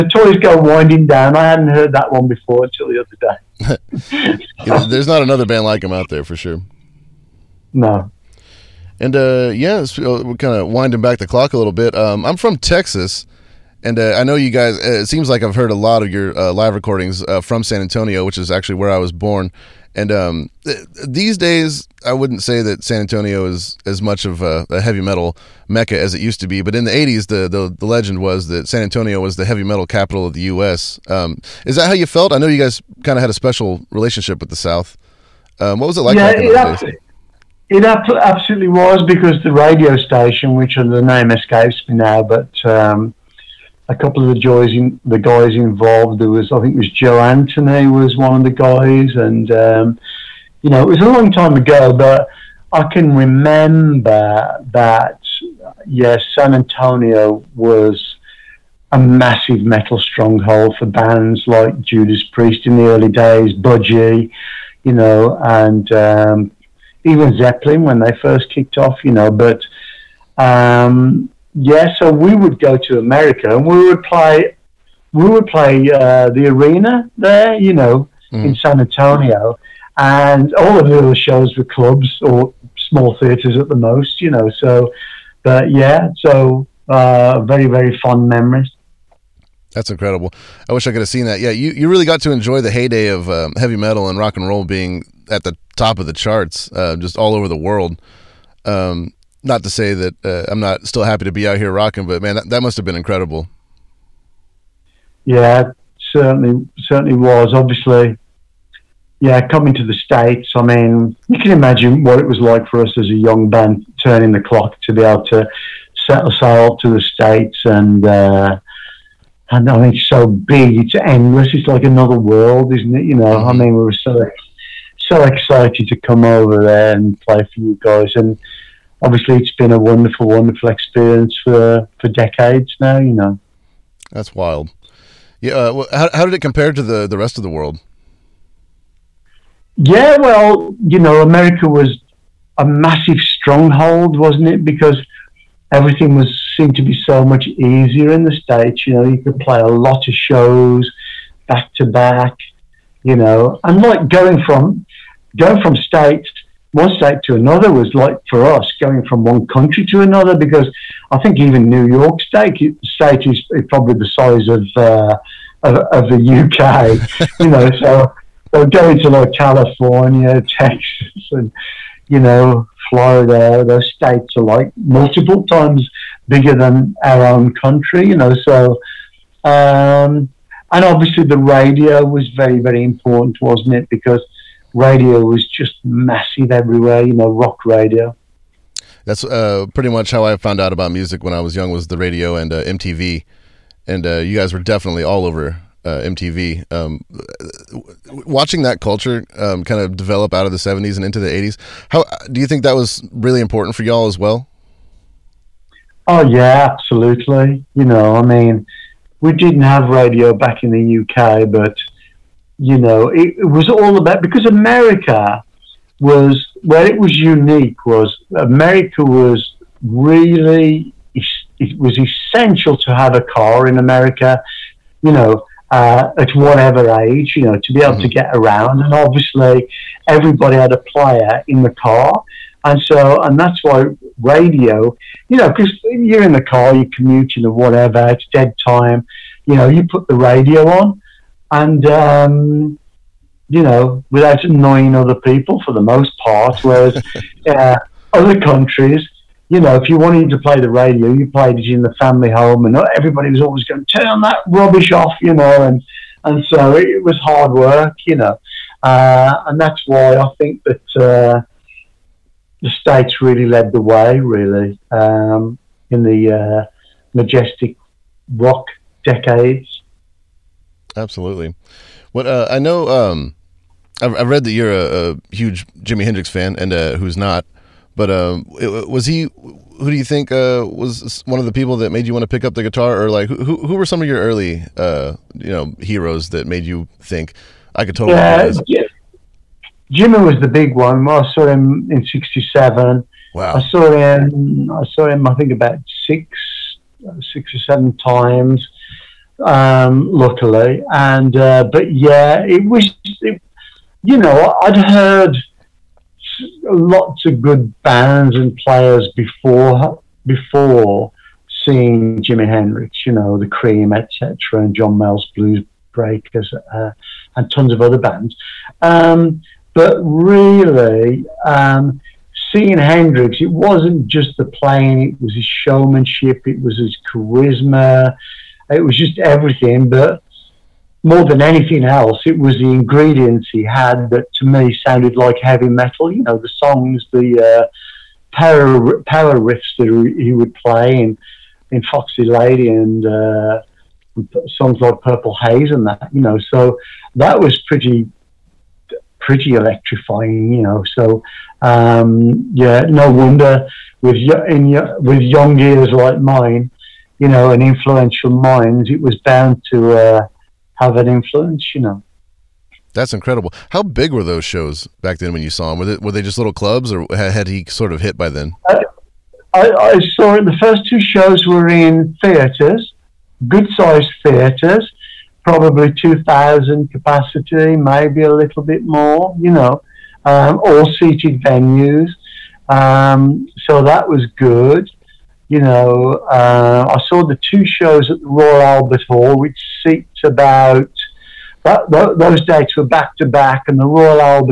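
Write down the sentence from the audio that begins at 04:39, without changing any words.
Who do you think uh, was one of the people that made you want to pick up the guitar, or like who?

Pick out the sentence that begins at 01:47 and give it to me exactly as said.
Obviously, yeah, coming to the states.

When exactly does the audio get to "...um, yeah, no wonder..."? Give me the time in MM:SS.
05:51.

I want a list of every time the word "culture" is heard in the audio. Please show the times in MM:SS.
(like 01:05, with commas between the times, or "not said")
03:18.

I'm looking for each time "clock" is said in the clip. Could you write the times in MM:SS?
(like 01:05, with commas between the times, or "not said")
00:11, 01:54.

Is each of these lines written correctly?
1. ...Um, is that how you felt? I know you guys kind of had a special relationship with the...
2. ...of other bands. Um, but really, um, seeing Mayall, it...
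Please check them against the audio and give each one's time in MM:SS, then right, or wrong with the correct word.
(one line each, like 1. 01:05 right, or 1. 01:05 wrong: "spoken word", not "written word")
1. 00:31 right
2. 05:17 wrong: "Hendrix", not "Mayall".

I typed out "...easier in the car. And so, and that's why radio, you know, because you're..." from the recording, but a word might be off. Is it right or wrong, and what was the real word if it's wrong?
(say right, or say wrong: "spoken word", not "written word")
wrong: "player", not "easier".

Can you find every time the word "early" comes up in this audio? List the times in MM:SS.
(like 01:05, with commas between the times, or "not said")
01:02, 04:44.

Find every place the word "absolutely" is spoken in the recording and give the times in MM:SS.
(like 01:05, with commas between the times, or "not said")
00:38, 03:26, 04:30.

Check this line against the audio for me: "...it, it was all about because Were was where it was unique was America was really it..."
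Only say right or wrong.
wrong.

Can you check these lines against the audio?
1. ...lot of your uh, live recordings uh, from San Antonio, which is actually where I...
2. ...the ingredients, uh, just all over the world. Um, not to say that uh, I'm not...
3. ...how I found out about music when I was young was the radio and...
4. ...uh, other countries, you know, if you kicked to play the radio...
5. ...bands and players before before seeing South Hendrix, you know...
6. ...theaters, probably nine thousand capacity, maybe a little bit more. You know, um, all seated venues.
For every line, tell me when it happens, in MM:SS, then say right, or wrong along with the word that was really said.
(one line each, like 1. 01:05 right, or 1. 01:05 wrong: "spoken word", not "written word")
1. 00:15 right
2. 01:36 wrong: "charts", not "ingredients"
3. 03:10 right
4. 04:07 wrong: "wanted", not "kicked"
5. 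05:07 wrong: "Jimi", not "South"
6. 06:14 wrong: "two", not "nine".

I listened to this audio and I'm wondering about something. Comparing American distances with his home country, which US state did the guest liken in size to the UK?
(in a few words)
New York.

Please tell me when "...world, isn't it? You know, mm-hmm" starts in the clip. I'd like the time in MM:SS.
02:02.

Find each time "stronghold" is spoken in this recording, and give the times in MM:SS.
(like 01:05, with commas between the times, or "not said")
00:59, 02:23.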